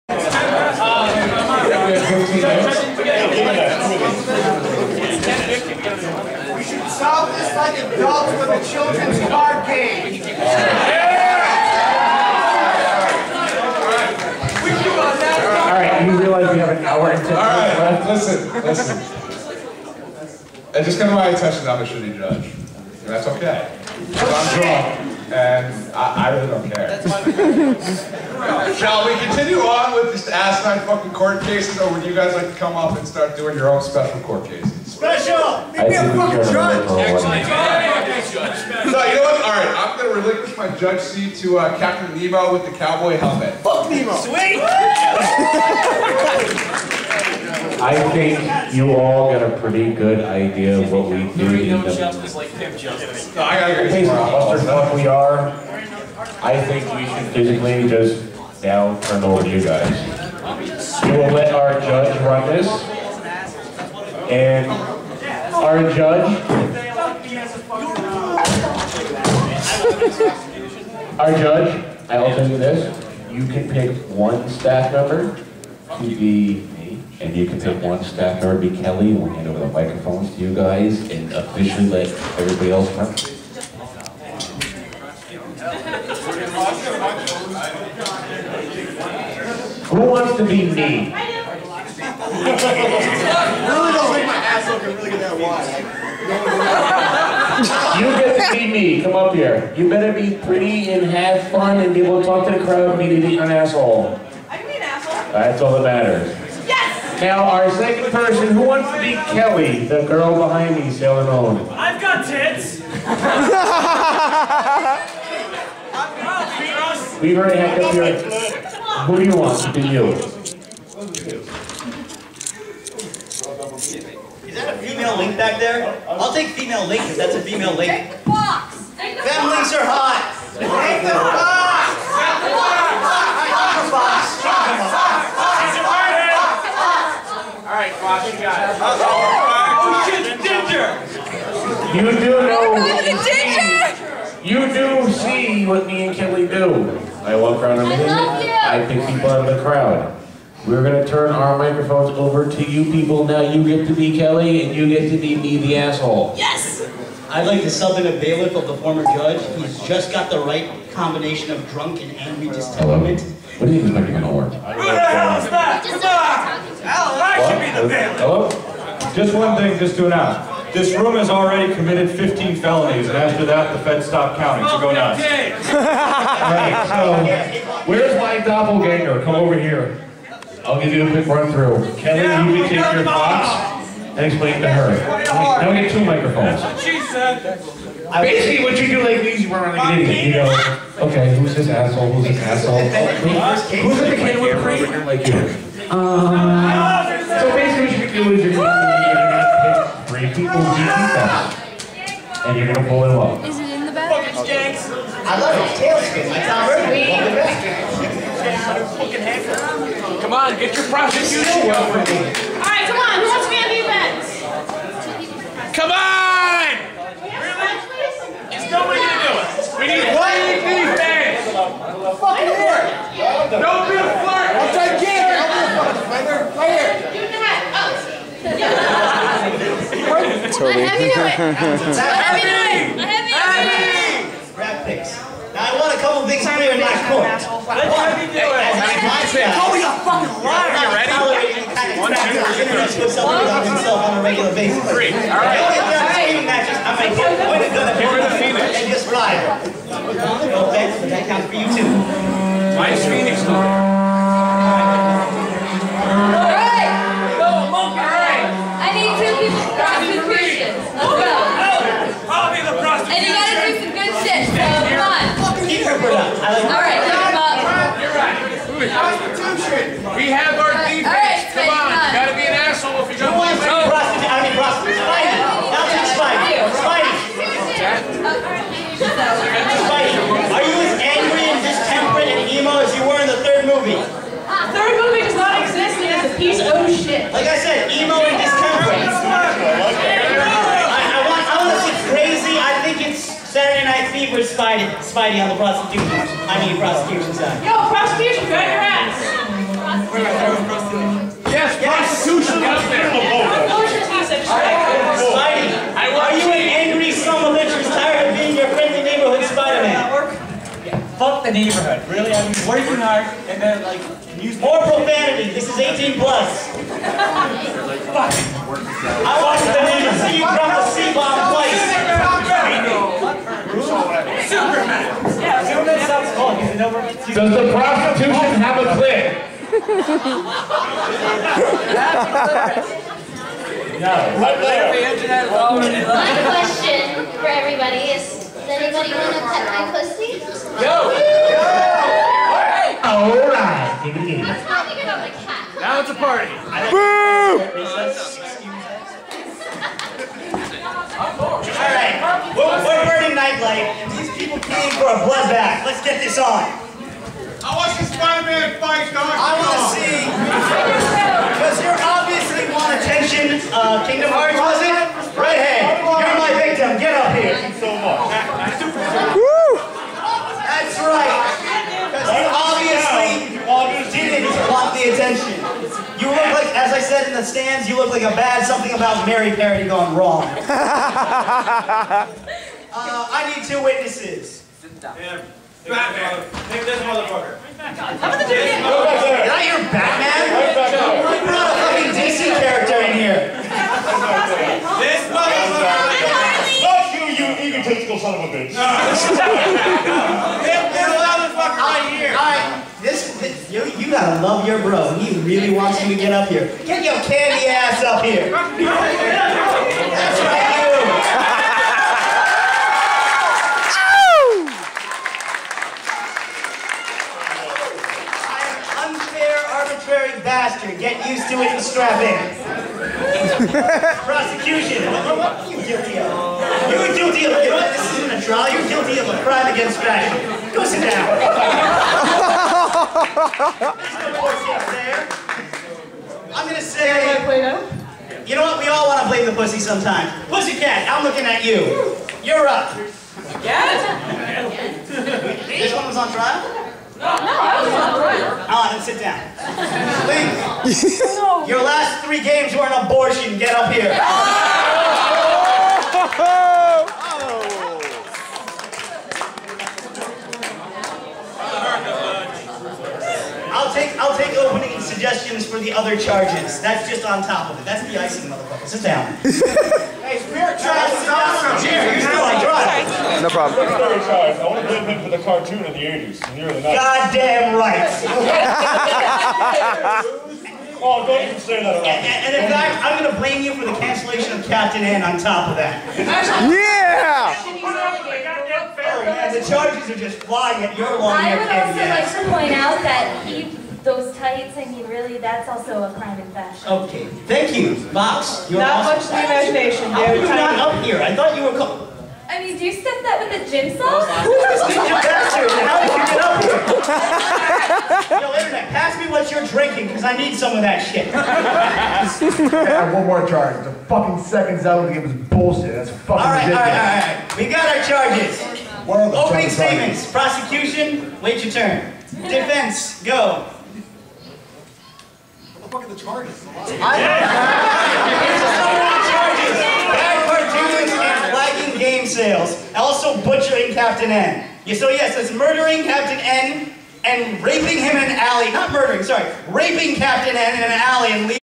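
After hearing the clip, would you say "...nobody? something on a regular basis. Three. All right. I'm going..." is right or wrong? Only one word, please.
wrong.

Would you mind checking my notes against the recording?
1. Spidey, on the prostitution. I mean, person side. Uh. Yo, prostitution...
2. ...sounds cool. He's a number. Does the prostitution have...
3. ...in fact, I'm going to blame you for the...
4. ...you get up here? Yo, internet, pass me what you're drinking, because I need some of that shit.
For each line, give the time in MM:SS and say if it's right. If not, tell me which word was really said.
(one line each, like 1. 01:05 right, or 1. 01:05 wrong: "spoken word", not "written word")
1. 04:54 wrong: "prostitution", not "person"
2. 05:26 right
3. 08:02 right
4. 08:26 right.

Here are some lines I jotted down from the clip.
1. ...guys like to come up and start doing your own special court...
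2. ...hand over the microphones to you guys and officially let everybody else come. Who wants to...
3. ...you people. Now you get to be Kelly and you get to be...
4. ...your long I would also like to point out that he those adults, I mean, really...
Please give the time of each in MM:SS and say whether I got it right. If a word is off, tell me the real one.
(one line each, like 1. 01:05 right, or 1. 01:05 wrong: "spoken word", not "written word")
1. 00:32 right
2. 01:19 right
3. 02:32 right
4. 08:10 wrong: "tights", not "adults".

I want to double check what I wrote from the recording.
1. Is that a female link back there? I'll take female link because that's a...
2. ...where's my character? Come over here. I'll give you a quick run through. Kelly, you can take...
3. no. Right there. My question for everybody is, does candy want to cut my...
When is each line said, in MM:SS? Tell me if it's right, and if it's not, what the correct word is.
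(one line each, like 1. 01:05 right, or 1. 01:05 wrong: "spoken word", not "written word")
1. 02:00 right
2. 02:57 wrong: "doppelganger", not "character"
3. 05:34 wrong: "anybody", not "candy".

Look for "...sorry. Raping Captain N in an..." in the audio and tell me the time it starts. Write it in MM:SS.
08:59.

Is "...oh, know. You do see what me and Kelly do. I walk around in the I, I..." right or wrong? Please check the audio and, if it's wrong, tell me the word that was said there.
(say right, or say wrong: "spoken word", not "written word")
right.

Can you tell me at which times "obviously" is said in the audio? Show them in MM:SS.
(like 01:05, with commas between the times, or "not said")
06:01.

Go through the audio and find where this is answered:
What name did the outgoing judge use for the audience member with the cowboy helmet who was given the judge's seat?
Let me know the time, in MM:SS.
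00:41.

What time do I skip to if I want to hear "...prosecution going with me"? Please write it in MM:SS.
03:30.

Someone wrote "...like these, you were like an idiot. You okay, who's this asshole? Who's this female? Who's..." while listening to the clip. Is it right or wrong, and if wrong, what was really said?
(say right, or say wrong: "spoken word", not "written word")
wrong: "asshole", not "female".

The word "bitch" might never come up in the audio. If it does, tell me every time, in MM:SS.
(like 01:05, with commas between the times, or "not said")
06:38.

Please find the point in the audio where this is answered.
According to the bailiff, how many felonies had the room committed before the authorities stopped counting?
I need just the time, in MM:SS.
02:52.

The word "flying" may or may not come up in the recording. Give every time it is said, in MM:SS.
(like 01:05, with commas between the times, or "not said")
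08:10.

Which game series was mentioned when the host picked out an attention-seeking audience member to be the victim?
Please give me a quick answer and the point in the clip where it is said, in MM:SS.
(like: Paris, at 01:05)
Kingdom Hearts, at 06:04.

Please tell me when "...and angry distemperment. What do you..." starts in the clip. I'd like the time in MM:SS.
02:42.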